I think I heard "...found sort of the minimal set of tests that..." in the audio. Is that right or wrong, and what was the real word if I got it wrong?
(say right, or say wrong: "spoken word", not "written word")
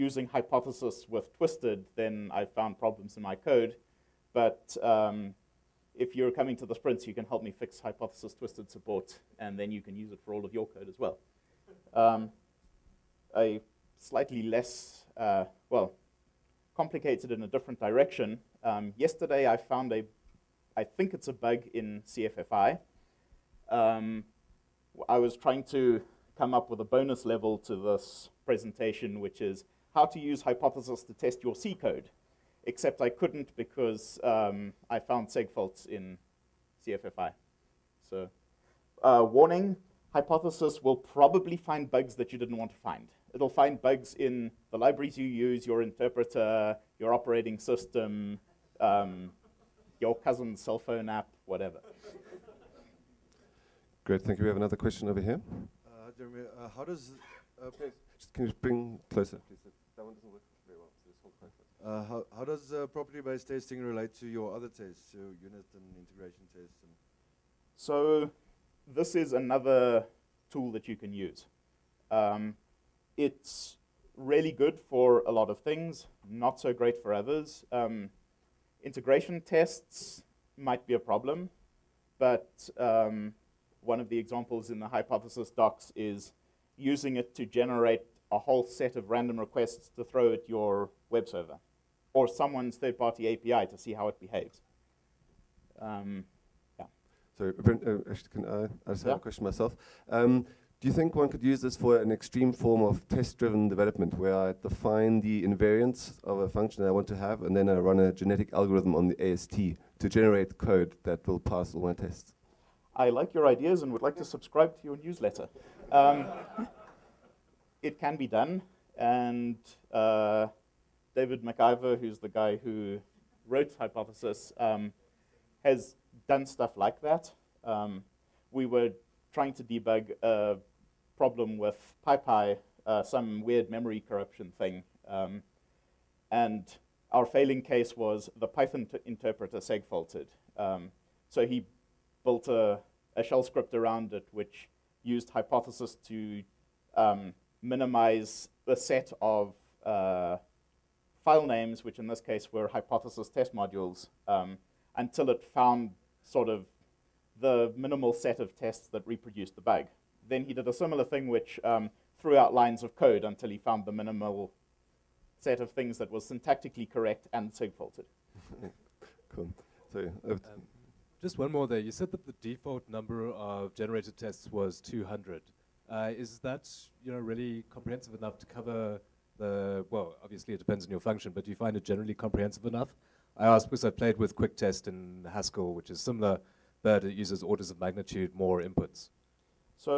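right.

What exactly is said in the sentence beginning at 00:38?
So uh, warning, hypothesis will probably find bugs that you didn't want to find.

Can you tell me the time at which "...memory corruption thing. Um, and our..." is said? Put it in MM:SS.
02:13.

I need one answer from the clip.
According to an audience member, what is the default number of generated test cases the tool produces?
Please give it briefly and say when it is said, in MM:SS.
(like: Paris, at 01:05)
200, at 02:54.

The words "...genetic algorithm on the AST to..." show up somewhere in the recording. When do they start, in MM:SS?
01:48.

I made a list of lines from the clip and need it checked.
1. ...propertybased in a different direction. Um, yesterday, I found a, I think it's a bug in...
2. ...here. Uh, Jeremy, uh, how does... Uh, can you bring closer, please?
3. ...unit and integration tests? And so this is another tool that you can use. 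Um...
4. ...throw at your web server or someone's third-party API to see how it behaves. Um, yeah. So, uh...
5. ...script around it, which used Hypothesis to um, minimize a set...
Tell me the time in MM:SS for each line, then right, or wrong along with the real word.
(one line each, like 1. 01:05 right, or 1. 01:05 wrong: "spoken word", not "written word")
1. 00:16 wrong: "complicated", not "propertybased"
2. 00:55 right
3. 01:05 right
4. 01:30 right
5. 02:23 right.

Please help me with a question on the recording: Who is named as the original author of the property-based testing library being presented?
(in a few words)
David MacIver.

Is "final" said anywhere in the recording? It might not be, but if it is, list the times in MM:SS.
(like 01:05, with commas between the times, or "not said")
not said.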